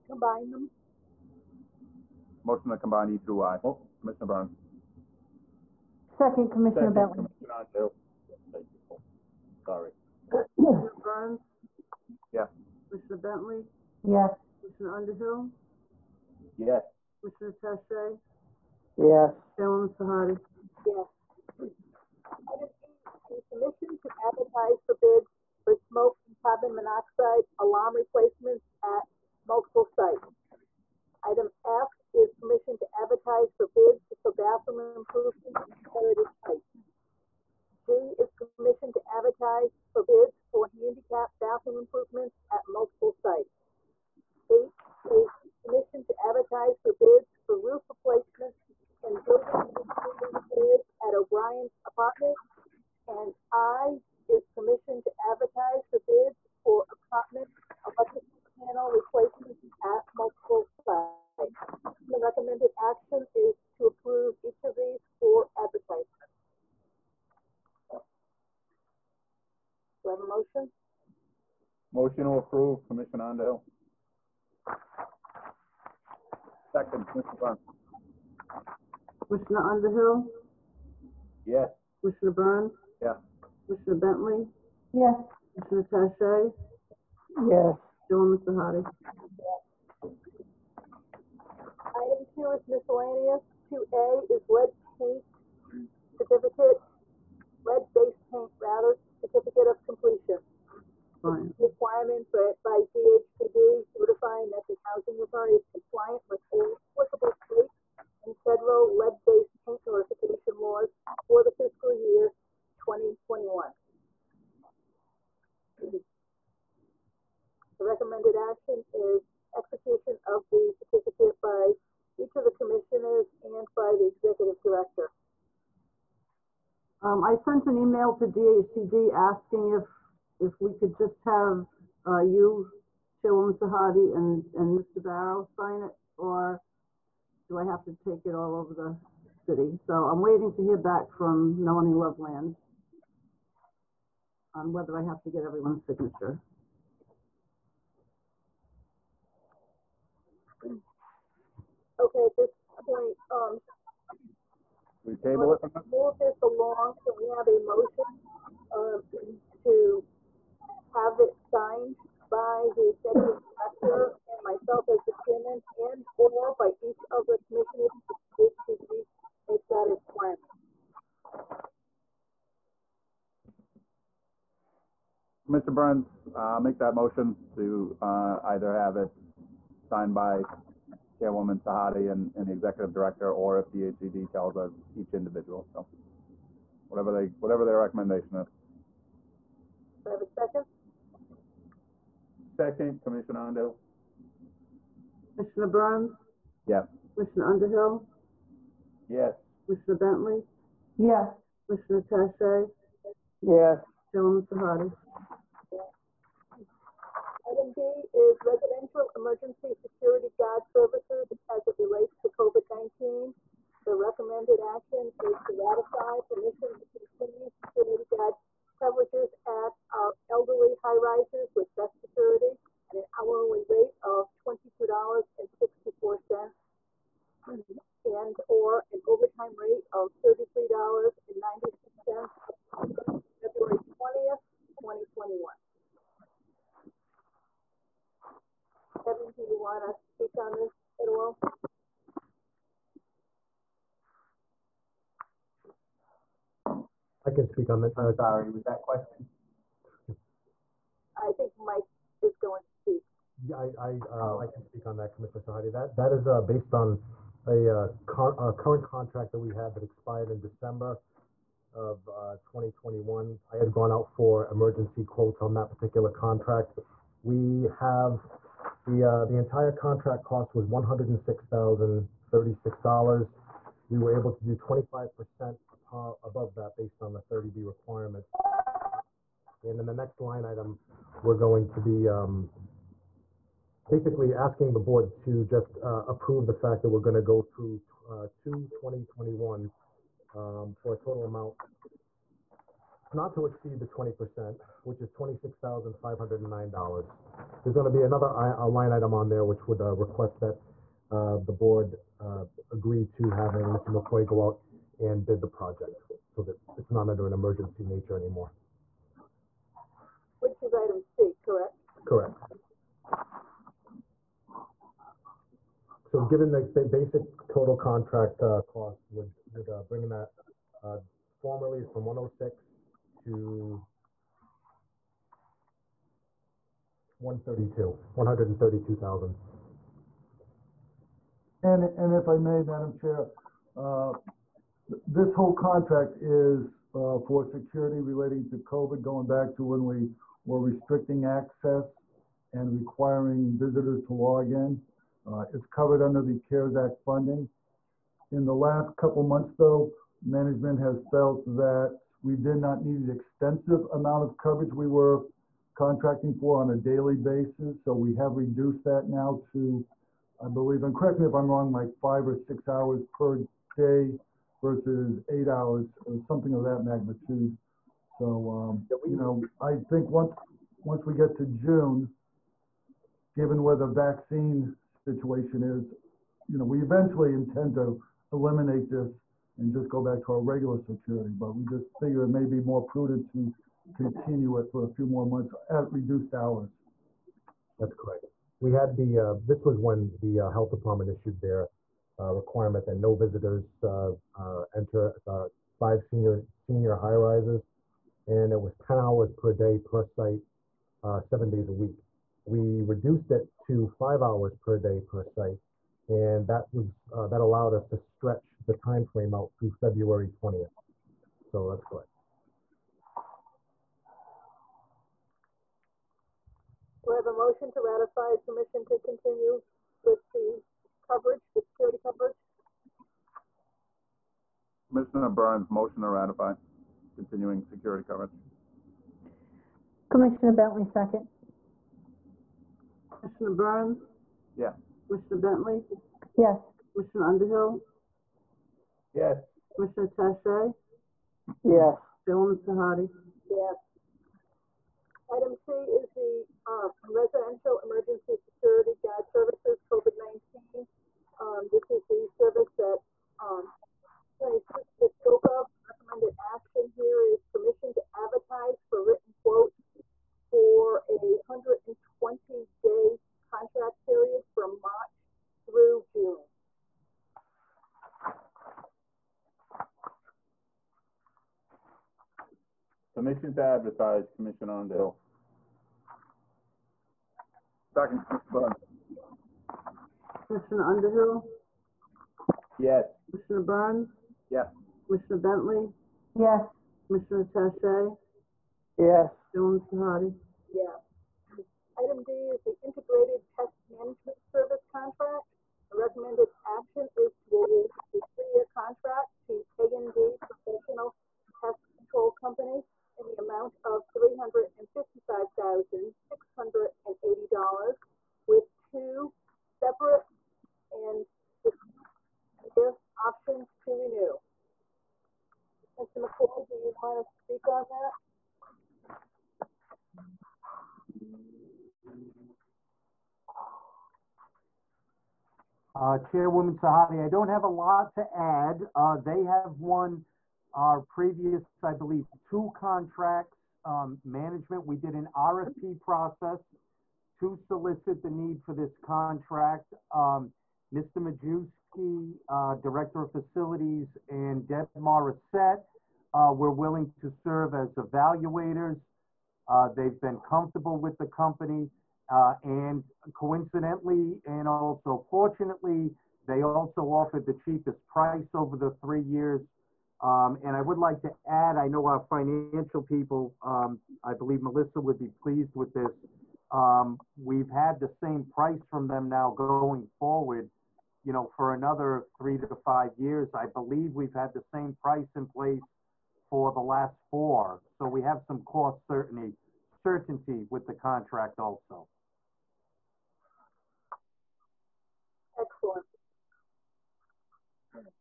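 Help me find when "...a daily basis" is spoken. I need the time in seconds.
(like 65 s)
356 s.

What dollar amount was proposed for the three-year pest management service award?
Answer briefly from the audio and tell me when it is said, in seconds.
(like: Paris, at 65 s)
$355,680, at 504 s.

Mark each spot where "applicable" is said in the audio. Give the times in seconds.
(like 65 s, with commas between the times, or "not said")
106 s.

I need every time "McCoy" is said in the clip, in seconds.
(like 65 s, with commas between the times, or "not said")
303 s, 516 s.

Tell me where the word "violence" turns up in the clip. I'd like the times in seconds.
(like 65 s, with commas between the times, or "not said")
not said.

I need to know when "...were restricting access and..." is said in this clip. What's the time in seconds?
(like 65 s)
340 s.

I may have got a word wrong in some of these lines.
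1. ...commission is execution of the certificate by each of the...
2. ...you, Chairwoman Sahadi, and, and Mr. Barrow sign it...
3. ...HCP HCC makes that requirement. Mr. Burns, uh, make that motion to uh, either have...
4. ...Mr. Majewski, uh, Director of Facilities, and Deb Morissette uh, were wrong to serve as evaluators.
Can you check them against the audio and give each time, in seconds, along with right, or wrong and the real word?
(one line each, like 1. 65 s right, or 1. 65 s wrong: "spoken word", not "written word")
1. 118 s wrong: "action", not "commission"
2. 132 s right
3. 168 s right
4. 540 s wrong: "willing", not "wrong".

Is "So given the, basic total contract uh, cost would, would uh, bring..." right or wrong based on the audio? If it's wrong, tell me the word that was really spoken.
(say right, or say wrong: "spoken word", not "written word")
right.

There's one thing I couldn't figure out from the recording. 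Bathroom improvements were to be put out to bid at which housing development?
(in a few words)
Heritage Heights.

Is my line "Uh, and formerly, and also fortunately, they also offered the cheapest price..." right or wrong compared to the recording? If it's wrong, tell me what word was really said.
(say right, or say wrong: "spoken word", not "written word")
wrong: "coincidentally", not "formerly".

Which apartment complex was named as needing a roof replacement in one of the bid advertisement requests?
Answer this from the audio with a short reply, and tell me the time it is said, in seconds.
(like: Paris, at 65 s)
O'Brien Apartments, at 51 s.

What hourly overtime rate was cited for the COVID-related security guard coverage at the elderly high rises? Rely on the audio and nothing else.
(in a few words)
$33.96.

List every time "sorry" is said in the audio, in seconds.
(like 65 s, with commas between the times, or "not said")
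9 s, 248 s.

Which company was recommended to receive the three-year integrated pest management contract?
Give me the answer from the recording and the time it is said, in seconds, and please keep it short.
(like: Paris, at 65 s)
A&D Professional Pest Control, at 499 s.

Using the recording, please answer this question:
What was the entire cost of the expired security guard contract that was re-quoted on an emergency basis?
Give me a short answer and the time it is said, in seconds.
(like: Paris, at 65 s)
$106,036, at 270 s.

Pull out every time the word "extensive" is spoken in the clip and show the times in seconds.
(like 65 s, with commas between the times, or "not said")
353 s.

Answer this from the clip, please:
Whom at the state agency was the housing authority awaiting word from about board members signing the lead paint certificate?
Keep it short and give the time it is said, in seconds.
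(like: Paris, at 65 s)
Melanie Loveland, at 141 s.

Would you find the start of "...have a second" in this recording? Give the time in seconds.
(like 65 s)
190 s.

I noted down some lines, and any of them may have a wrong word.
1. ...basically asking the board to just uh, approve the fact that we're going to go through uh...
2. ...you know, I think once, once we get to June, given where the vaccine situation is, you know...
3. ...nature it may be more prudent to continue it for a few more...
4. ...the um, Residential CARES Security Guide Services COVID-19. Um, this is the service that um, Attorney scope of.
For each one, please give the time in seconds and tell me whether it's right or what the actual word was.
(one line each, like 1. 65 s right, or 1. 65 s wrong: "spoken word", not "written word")
1. 283 s right
2. 369 s right
3. 382 s wrong: "figure", not "nature"
4. 446 s wrong: "Emergency", not "CARES".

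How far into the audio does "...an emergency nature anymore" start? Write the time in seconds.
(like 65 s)
307 s.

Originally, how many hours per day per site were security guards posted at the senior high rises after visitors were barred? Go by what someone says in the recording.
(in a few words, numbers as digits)
10.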